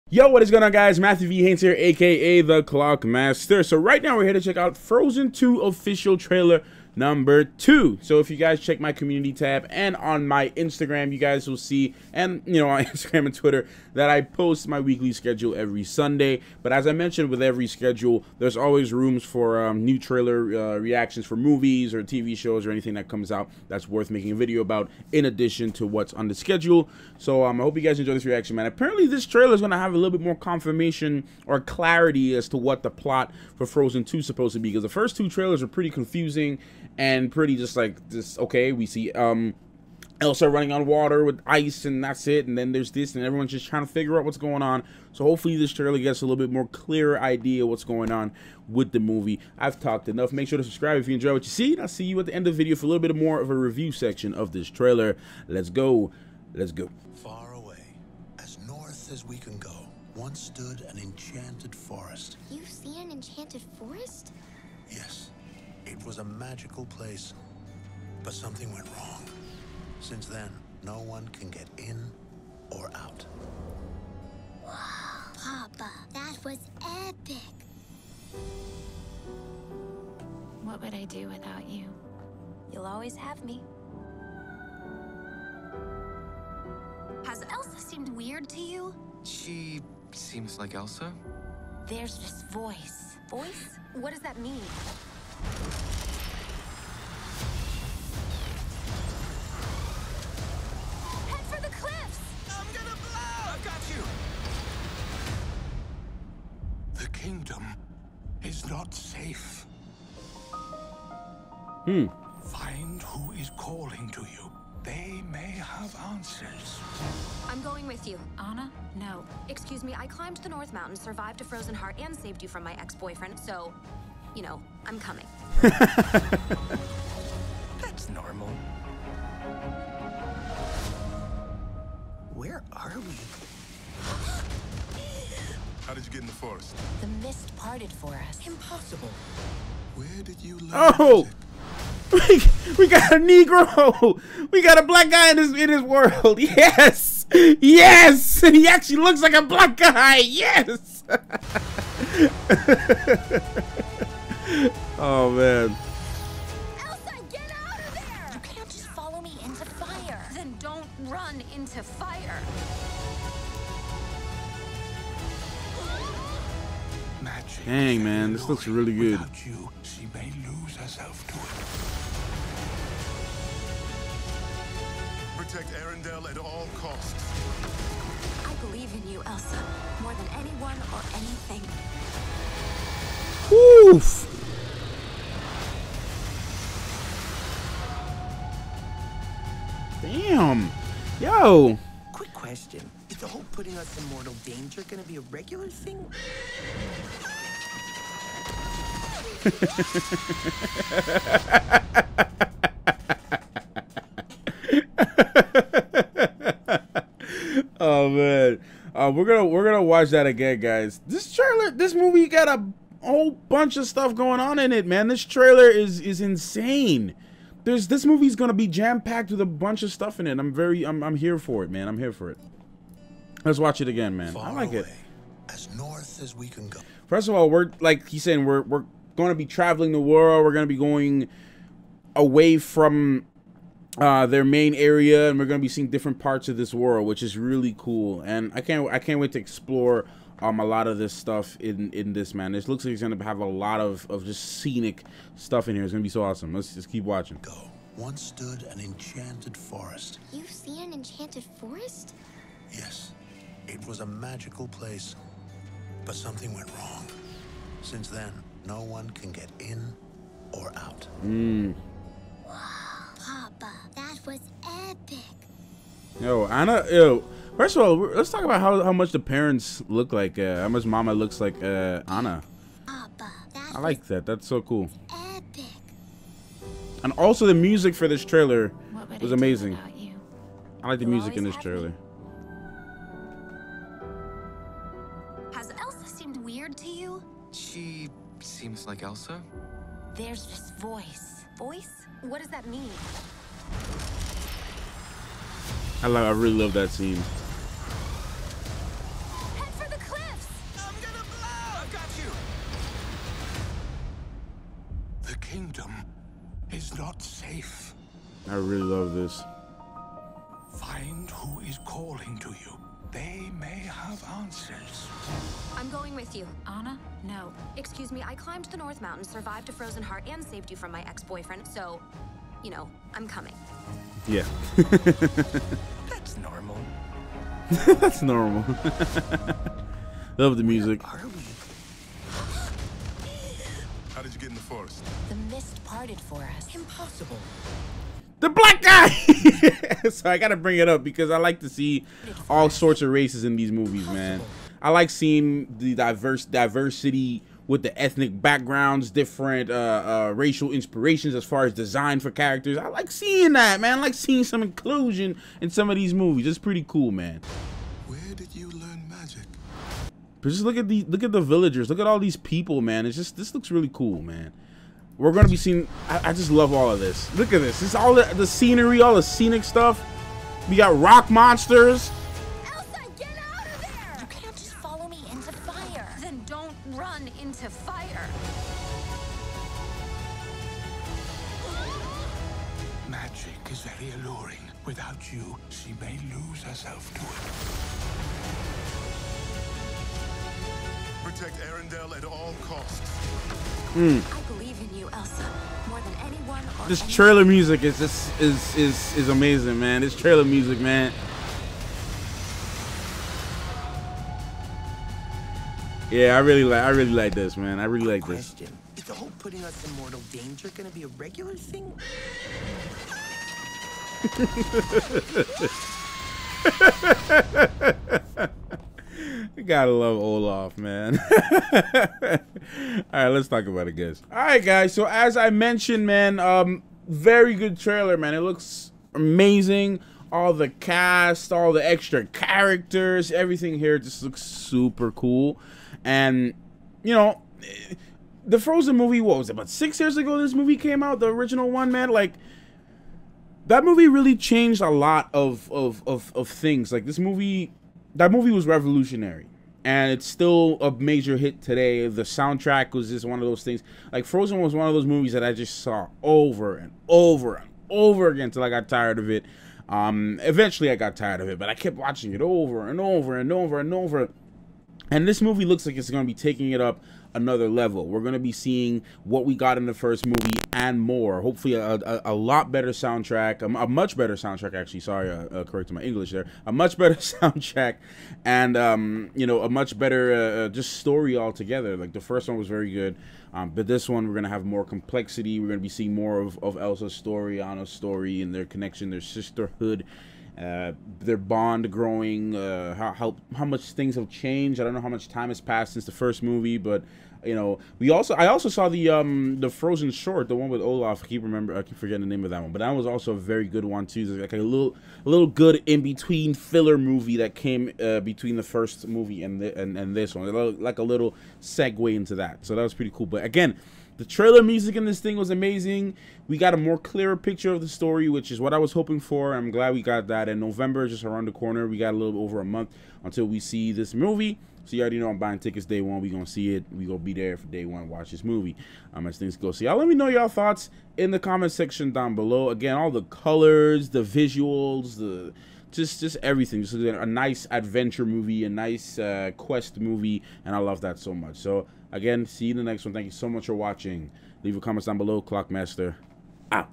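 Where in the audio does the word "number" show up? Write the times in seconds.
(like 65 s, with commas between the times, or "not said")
6 s.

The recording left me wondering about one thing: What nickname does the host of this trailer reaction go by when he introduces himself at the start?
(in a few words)
The Clock Master.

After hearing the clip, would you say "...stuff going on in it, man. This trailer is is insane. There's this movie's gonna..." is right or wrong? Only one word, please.
right.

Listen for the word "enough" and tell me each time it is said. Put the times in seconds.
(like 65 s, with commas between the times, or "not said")
50 s.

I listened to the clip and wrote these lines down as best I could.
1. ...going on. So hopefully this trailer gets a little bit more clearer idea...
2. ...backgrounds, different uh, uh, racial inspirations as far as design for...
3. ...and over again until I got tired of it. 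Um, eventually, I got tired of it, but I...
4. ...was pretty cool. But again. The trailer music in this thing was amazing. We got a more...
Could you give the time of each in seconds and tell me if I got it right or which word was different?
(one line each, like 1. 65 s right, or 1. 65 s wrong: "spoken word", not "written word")
1. 44 s right
2. 348 s right
3. 457 s right
4. 512 s right.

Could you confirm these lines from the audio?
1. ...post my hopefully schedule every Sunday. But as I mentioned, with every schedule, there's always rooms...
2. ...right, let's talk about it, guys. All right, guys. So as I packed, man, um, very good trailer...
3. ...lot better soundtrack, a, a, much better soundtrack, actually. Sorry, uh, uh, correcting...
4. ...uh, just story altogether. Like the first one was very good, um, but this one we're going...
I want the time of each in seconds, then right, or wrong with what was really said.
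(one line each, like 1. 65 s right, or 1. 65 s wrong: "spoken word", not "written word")
1. 14 s wrong: "weekly", not "hopefully"
2. 423 s wrong: "mentioned", not "packed"
3. 472 s right
4. 480 s right.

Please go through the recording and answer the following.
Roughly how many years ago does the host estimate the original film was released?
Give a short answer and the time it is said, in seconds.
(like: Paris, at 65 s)
6 years, at 439 s.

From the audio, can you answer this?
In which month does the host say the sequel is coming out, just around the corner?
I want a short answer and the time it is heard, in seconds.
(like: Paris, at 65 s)
November, at 520 s.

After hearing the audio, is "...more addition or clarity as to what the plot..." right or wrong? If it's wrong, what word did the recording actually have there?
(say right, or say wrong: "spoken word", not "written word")
wrong: "confirmation", not "addition".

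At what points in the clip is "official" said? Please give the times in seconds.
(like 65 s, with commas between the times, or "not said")
5 s.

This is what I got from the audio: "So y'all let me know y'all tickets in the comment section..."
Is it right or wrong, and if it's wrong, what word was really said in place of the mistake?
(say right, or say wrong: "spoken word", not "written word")
wrong: "thoughts", not "tickets".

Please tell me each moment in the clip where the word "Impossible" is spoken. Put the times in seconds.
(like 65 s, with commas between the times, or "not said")
138 s, 336 s.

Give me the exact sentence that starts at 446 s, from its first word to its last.
Like, this movie, that movie was revolutionary and it's still a major hit today.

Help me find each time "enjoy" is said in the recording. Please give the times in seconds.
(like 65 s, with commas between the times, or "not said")
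27 s, 51 s.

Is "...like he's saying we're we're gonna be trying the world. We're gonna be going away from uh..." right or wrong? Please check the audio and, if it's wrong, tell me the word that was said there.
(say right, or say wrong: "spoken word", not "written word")
wrong: "traveling", not "trying".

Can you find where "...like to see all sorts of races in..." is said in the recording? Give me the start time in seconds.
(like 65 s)
341 s.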